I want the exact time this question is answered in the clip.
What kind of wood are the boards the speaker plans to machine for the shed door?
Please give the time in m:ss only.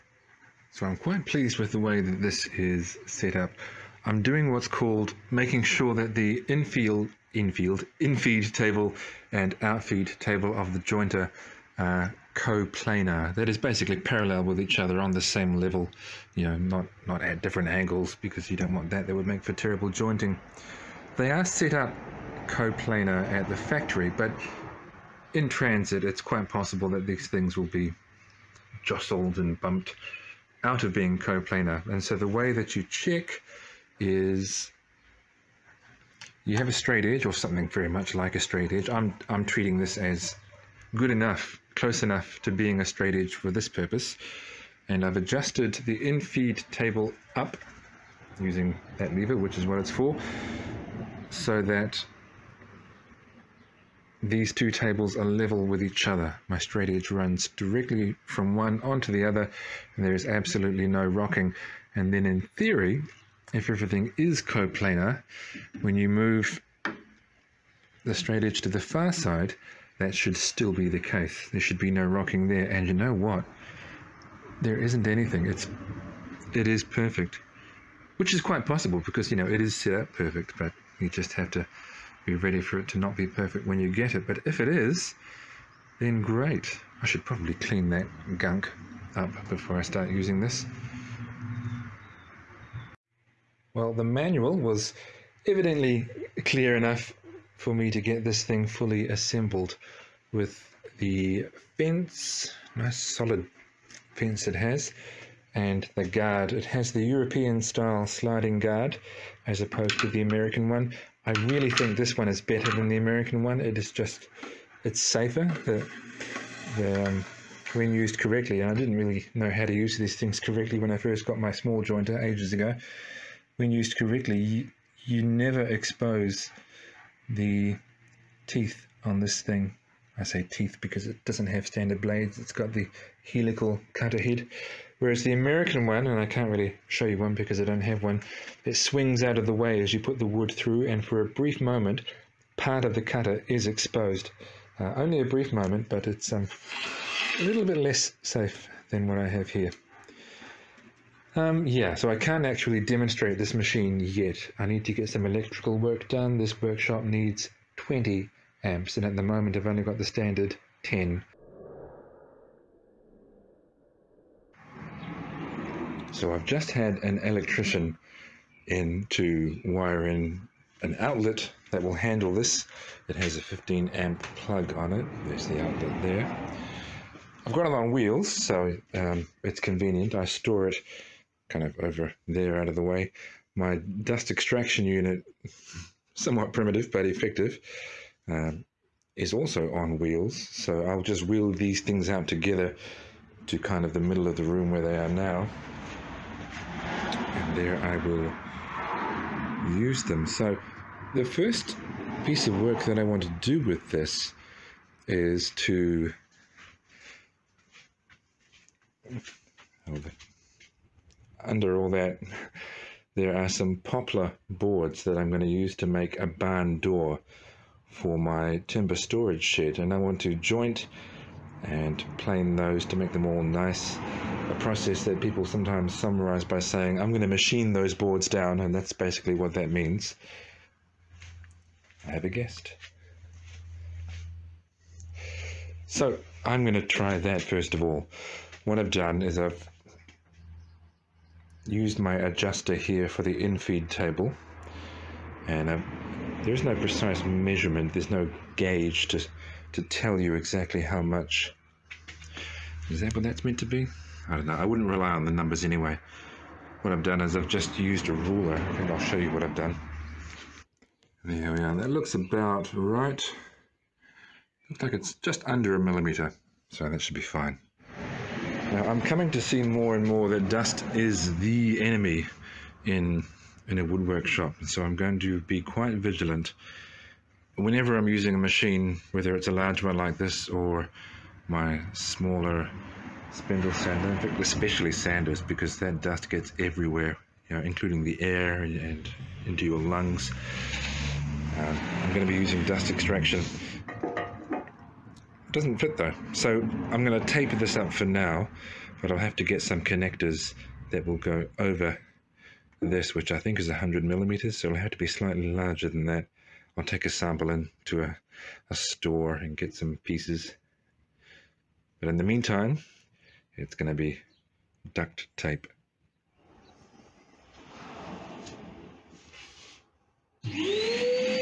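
3:33.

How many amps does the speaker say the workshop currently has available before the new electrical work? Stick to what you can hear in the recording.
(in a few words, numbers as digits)
10.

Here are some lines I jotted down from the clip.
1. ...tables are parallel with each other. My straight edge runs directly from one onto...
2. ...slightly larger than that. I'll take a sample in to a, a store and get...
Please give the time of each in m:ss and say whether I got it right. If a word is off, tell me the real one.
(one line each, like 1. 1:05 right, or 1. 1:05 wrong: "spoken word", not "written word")
1. 0:54 wrong: "level", not "parallel"
2. 5:05 right.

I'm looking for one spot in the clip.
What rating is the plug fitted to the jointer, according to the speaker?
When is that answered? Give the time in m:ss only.
2:53.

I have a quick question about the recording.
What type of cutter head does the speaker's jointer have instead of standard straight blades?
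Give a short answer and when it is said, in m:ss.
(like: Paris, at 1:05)
helical cutter head, at 2:13.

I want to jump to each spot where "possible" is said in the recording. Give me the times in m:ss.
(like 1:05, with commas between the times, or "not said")
0:26, 1:18.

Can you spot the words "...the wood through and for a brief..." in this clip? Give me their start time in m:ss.
2:20.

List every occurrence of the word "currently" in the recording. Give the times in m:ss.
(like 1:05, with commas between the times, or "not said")
not said.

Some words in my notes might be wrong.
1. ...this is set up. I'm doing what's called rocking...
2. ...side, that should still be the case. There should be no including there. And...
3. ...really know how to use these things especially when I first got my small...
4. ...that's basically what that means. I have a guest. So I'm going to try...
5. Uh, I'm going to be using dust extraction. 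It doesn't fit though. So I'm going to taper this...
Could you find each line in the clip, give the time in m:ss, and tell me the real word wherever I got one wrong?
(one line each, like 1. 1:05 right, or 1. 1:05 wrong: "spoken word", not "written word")
1. 0:02 wrong: "making", not "rocking"
2. 1:09 wrong: "rocking", not "including"
3. 1:58 wrong: "correctly", not "especially"
4. 3:48 right
5. 4:51 right.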